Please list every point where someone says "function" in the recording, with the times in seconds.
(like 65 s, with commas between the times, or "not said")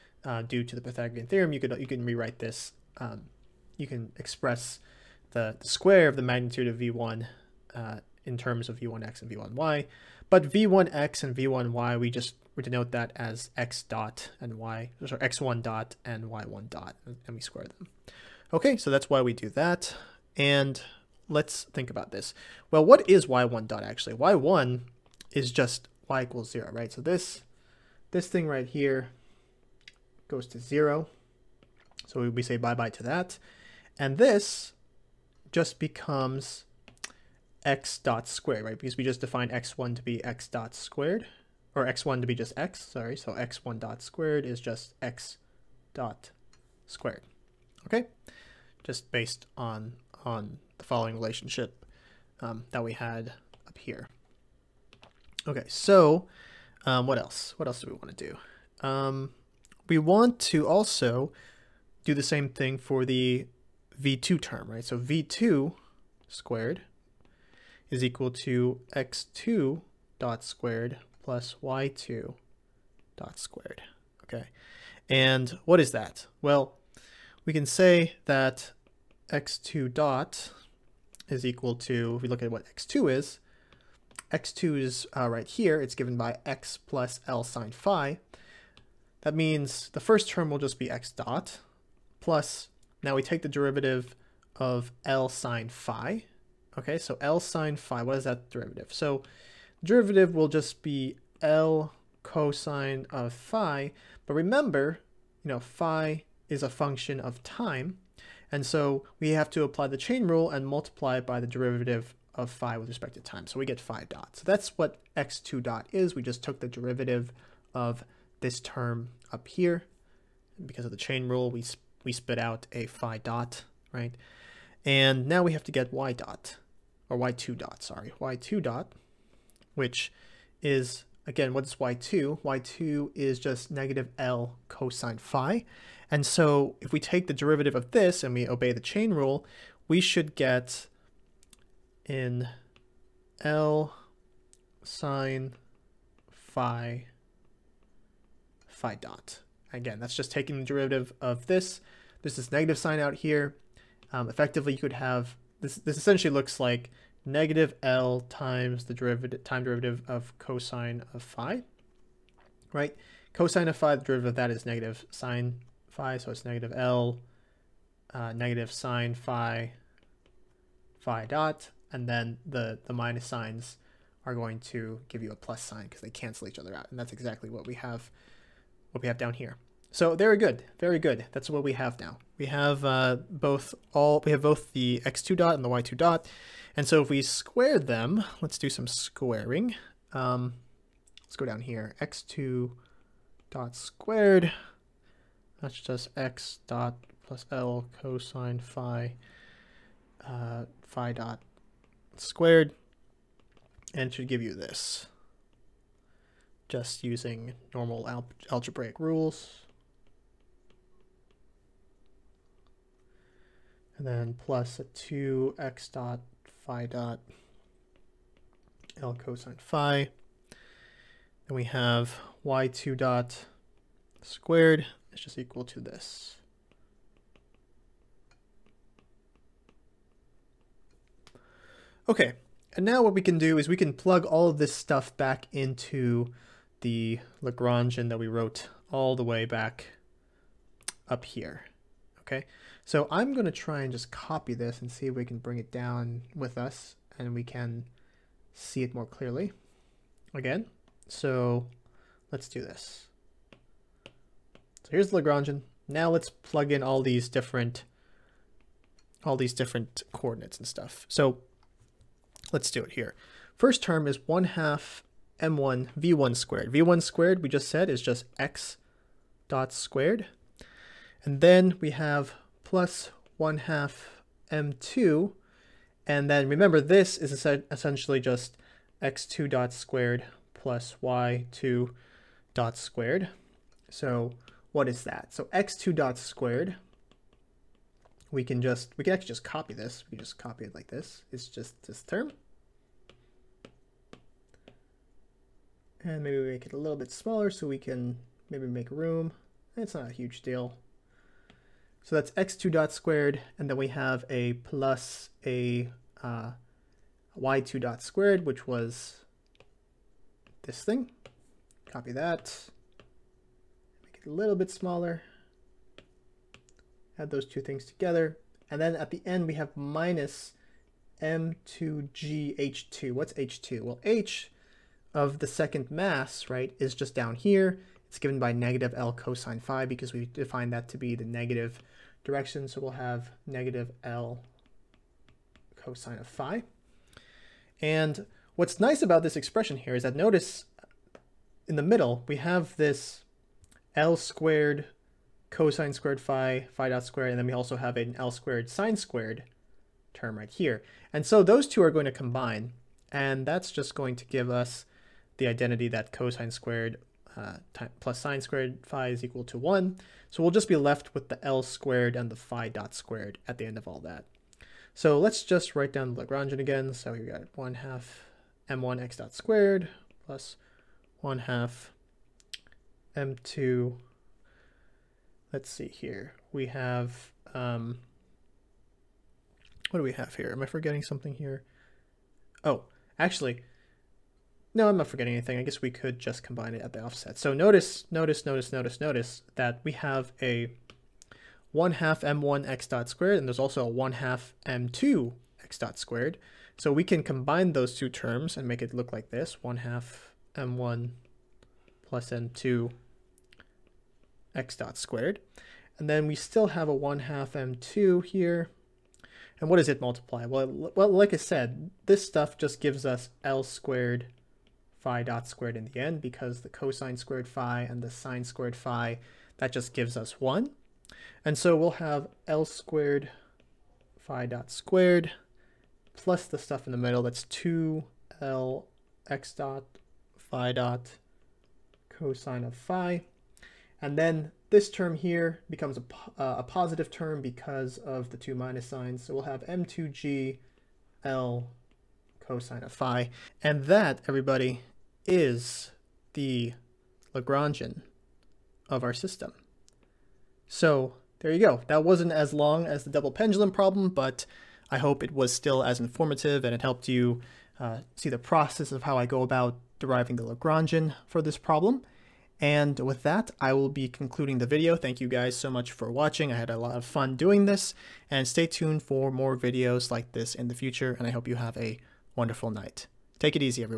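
106 s.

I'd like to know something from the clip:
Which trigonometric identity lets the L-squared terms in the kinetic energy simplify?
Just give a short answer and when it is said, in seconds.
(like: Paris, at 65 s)
cos²φ + sin²φ = 1, at 356 s.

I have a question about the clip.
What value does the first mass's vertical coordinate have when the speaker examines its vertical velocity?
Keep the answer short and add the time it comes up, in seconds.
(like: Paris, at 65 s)
y = 0, at 26 s.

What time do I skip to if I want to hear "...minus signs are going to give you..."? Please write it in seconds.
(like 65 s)
172 s.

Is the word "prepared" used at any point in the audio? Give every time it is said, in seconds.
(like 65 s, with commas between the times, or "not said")
not said.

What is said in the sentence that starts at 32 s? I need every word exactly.
So we say bye-bye to that.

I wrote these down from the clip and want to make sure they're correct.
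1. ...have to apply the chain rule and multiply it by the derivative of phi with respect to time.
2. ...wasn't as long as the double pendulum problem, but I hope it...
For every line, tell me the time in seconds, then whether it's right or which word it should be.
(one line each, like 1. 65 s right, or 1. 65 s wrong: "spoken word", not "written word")
1. 109 s right
2. 452 s right.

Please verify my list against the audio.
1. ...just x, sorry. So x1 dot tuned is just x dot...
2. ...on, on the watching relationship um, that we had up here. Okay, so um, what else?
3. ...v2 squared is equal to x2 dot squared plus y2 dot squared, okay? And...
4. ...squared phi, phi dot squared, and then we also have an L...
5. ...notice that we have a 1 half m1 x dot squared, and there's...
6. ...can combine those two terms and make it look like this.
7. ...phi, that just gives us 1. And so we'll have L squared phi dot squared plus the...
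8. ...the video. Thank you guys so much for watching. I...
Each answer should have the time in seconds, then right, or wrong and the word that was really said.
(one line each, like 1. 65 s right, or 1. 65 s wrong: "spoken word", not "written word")
1. 42 s wrong: "squared", not "tuned"
2. 49 s wrong: "following", not "watching"
3. 64 s right
4. 345 s right
5. 389 s right
6. 397 s right
7. 418 s right
8. 464 s right.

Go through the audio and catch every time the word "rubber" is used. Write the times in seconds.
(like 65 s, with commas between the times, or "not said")
not said.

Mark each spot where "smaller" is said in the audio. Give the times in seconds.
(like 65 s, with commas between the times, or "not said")
297 s, 314 s.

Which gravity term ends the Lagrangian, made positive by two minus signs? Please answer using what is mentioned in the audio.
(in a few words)
m2 g L cos phi.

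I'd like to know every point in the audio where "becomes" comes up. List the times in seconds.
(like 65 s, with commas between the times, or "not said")
35 s, 435 s.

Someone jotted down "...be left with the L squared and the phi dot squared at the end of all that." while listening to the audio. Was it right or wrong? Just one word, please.
right.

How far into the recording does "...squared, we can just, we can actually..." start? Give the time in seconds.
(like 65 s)
286 s.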